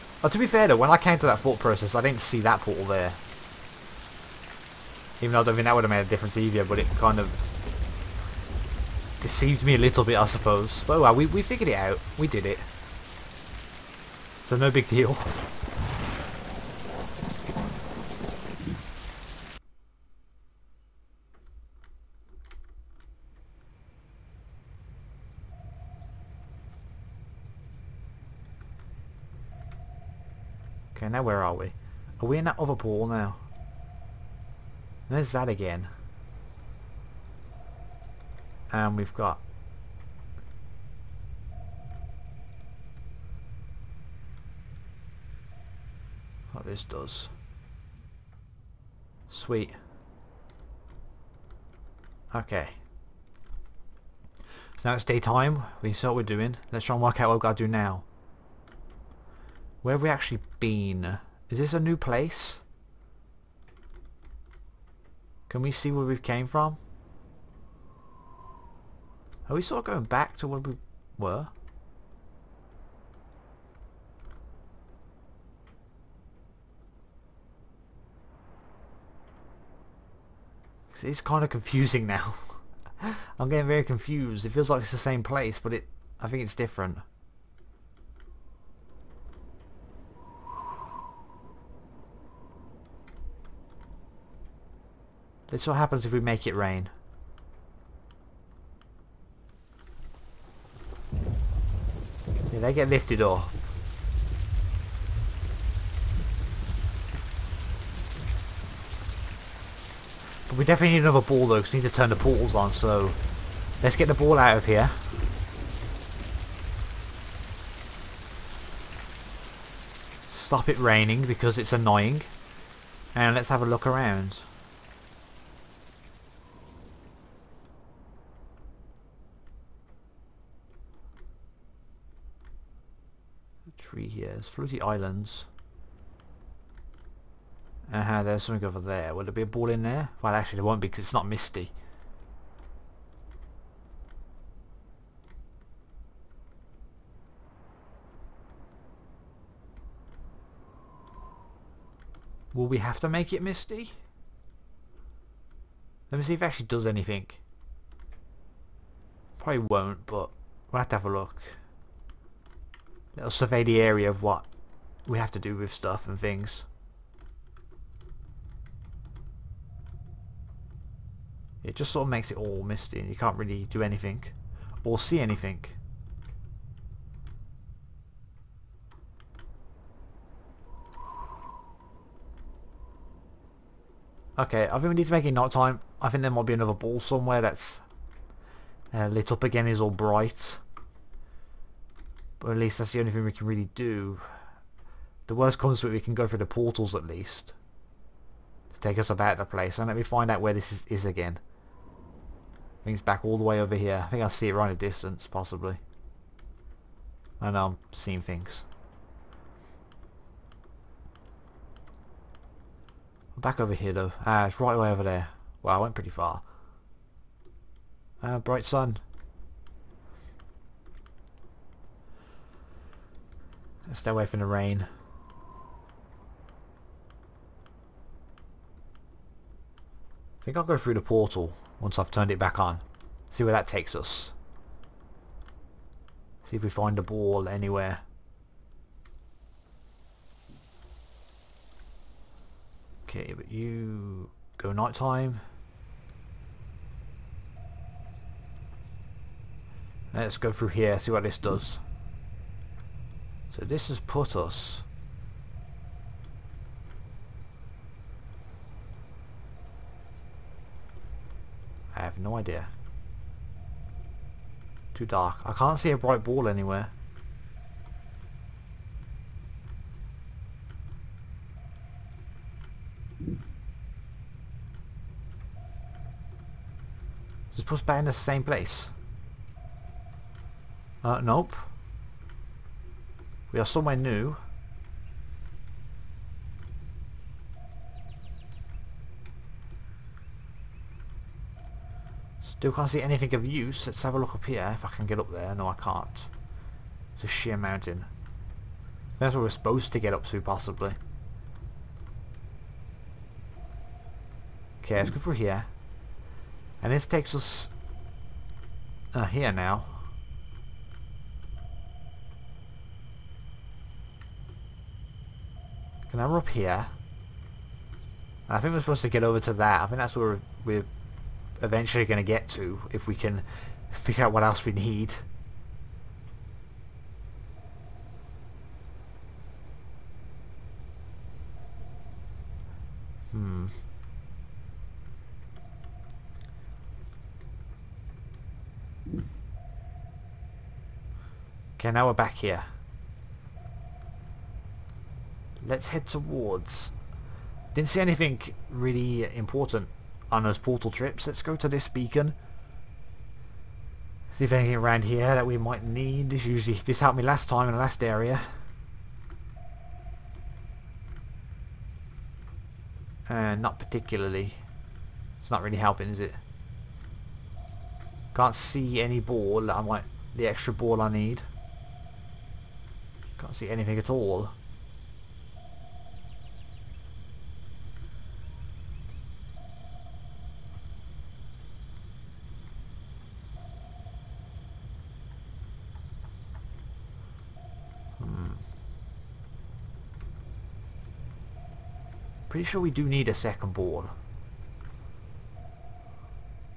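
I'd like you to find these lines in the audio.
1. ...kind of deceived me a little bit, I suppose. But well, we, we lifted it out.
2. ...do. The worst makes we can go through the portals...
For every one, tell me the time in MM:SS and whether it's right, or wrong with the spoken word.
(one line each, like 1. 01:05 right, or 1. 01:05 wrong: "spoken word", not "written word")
1. 00:06 wrong: "figured", not "lifted"
2. 03:13 wrong: "comes", not "makes".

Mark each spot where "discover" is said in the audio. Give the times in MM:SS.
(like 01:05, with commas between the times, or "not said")
not said.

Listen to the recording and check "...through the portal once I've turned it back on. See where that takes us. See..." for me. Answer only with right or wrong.
right.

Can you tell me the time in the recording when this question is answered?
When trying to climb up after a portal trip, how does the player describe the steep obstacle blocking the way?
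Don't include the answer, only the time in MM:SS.
04:57.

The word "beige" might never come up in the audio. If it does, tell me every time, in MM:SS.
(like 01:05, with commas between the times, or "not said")
not said.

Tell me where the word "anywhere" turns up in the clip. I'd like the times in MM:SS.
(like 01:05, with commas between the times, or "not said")
03:57, 04:26.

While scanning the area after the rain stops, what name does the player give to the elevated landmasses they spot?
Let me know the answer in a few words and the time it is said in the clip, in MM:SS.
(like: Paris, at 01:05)
Floaty Islands, at 02:14.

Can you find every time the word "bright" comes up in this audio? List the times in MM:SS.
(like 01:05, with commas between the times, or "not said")
03:09, 03:38, 04:25.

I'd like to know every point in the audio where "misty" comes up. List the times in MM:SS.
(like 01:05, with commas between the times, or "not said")
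02:21, 02:33, 02:52.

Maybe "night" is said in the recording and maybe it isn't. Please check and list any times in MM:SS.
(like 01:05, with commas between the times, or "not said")
03:05, 04:04.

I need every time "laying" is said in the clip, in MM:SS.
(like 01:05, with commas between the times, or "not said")
not said.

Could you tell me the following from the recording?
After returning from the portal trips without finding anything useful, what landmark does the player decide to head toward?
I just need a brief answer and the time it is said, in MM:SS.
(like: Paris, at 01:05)
this beacon, at 05:51.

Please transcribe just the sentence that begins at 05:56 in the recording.
This usually this helped me last time in the last area.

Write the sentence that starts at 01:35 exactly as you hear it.
This what happens if we make it rain.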